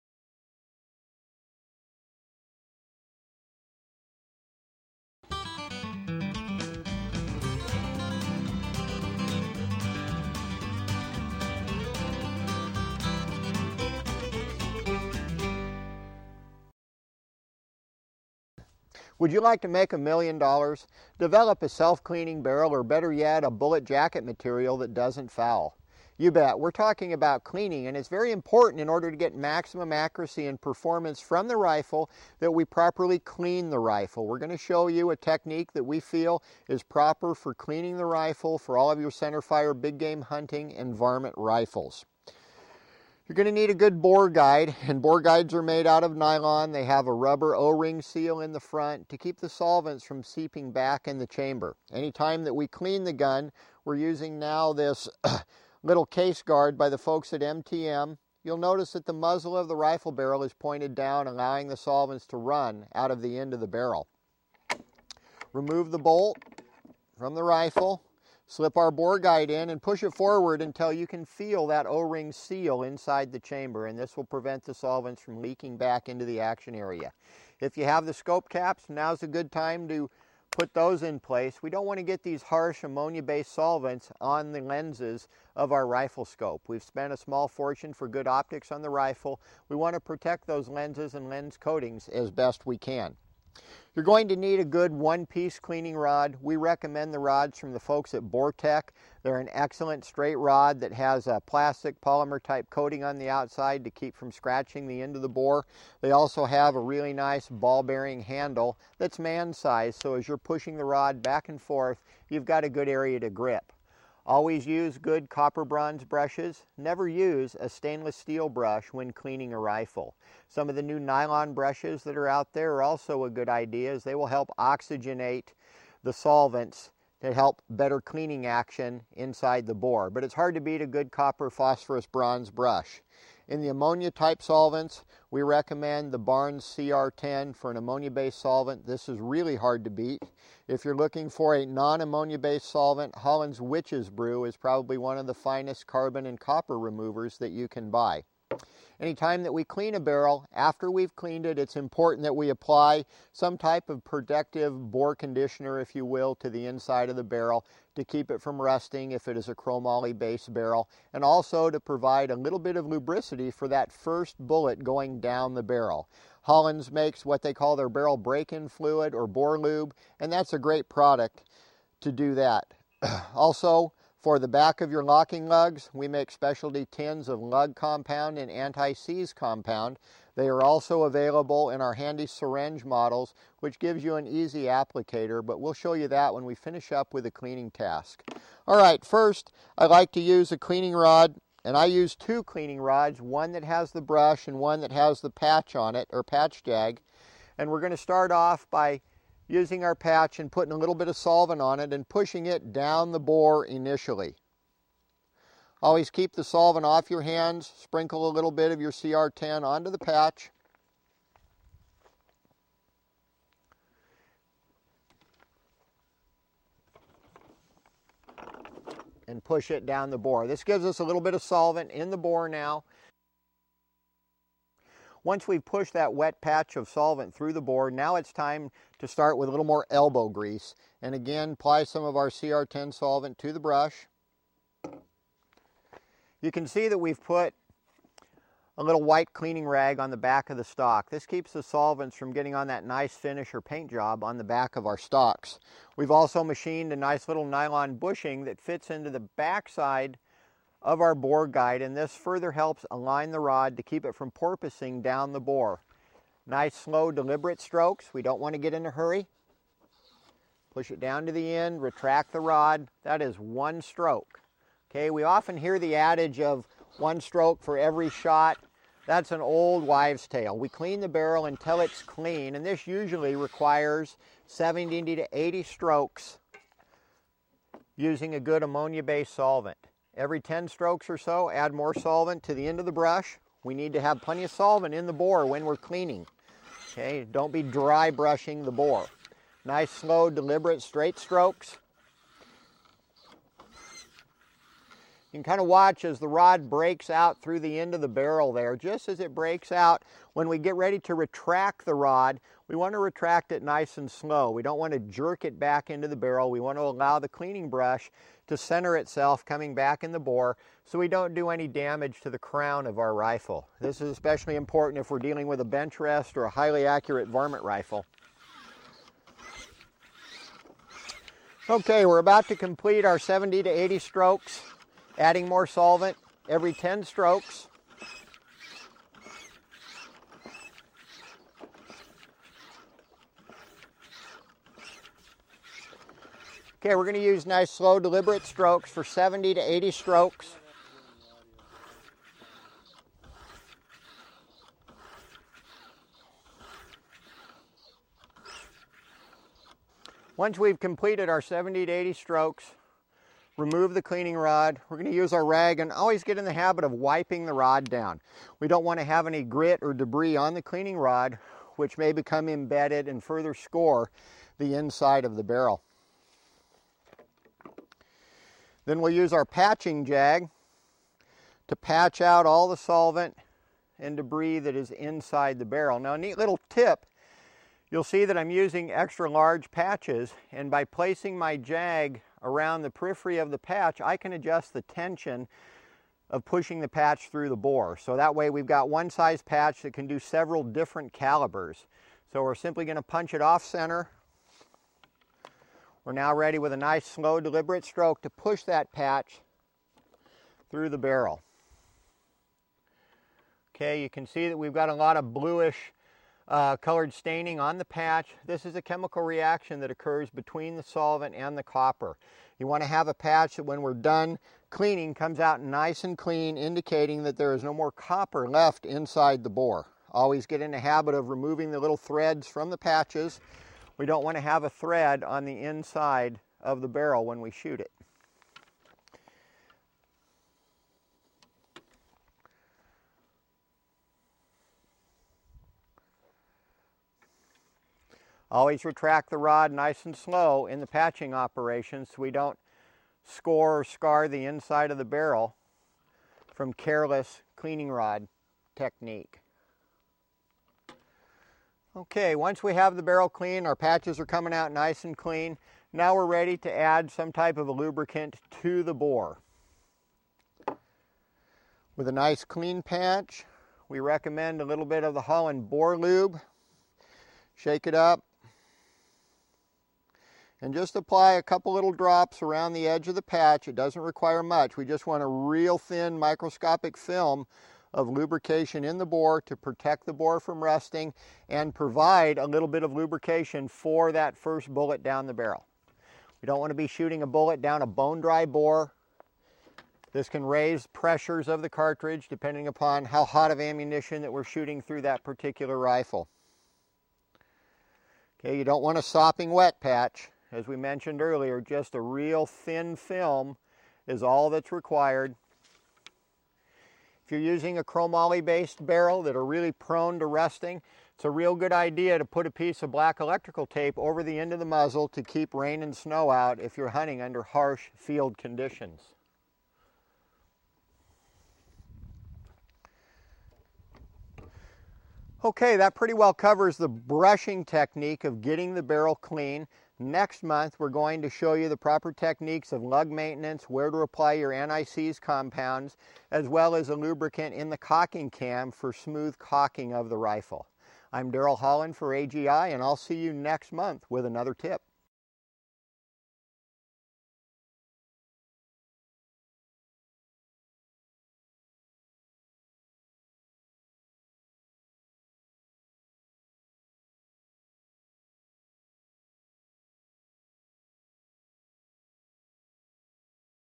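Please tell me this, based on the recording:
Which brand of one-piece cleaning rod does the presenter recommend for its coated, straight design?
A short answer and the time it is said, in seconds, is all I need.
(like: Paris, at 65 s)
Bore Tech, at 98 s.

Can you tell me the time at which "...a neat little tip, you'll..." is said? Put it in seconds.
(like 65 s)
376 s.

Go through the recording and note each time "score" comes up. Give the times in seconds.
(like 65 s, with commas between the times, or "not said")
363 s, 443 s.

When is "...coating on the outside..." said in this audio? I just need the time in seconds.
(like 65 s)
102 s.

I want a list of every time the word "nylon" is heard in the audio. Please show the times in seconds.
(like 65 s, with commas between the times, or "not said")
46 s, 120 s, 247 s.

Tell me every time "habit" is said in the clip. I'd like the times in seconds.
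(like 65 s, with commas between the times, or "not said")
356 s, 420 s.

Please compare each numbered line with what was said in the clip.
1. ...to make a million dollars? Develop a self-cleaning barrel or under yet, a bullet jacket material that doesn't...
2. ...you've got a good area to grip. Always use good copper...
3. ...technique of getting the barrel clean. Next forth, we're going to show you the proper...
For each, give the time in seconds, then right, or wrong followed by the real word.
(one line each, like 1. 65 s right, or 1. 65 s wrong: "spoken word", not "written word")
1. 19 s wrong: "better", not "under"
2. 112 s right
3. 527 s wrong: "month", not "forth".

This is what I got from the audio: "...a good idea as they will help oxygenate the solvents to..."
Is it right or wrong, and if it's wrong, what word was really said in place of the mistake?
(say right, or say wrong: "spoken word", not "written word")
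right.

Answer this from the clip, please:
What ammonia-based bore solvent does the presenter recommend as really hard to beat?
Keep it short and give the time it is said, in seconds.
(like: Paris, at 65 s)
Barnes CR10, at 136 s.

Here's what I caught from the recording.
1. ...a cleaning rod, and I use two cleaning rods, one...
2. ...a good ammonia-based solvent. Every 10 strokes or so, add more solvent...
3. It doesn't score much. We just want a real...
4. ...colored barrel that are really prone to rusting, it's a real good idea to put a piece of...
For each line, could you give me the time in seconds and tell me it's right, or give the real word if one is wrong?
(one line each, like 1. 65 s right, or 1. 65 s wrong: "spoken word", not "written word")
1. 190 s right
2. 278 s right
3. 473 s wrong: "require", not "score"
4. 508 s wrong: "based", not "colored".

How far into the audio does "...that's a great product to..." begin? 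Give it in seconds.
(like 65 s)
170 s.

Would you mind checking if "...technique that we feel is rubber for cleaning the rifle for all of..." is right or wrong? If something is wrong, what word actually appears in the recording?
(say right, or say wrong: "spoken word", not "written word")
wrong: "proper", not "rubber".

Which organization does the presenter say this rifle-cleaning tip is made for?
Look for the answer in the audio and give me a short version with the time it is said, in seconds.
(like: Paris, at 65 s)
AGI, at 542 s.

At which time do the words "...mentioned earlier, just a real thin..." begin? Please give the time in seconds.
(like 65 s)
500 s.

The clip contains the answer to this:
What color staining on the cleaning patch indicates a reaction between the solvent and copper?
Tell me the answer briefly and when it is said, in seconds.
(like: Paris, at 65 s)
Bluish, at 405 s.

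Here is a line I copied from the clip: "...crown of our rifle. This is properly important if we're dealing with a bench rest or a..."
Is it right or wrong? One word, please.
wrong.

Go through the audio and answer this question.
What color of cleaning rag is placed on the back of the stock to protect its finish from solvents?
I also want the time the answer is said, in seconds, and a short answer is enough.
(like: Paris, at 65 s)
White, at 239 s.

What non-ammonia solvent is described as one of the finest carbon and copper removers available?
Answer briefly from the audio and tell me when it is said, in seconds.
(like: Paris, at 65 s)
Holland's Witch's Brew, at 143 s.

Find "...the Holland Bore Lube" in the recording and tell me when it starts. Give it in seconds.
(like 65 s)
465 s.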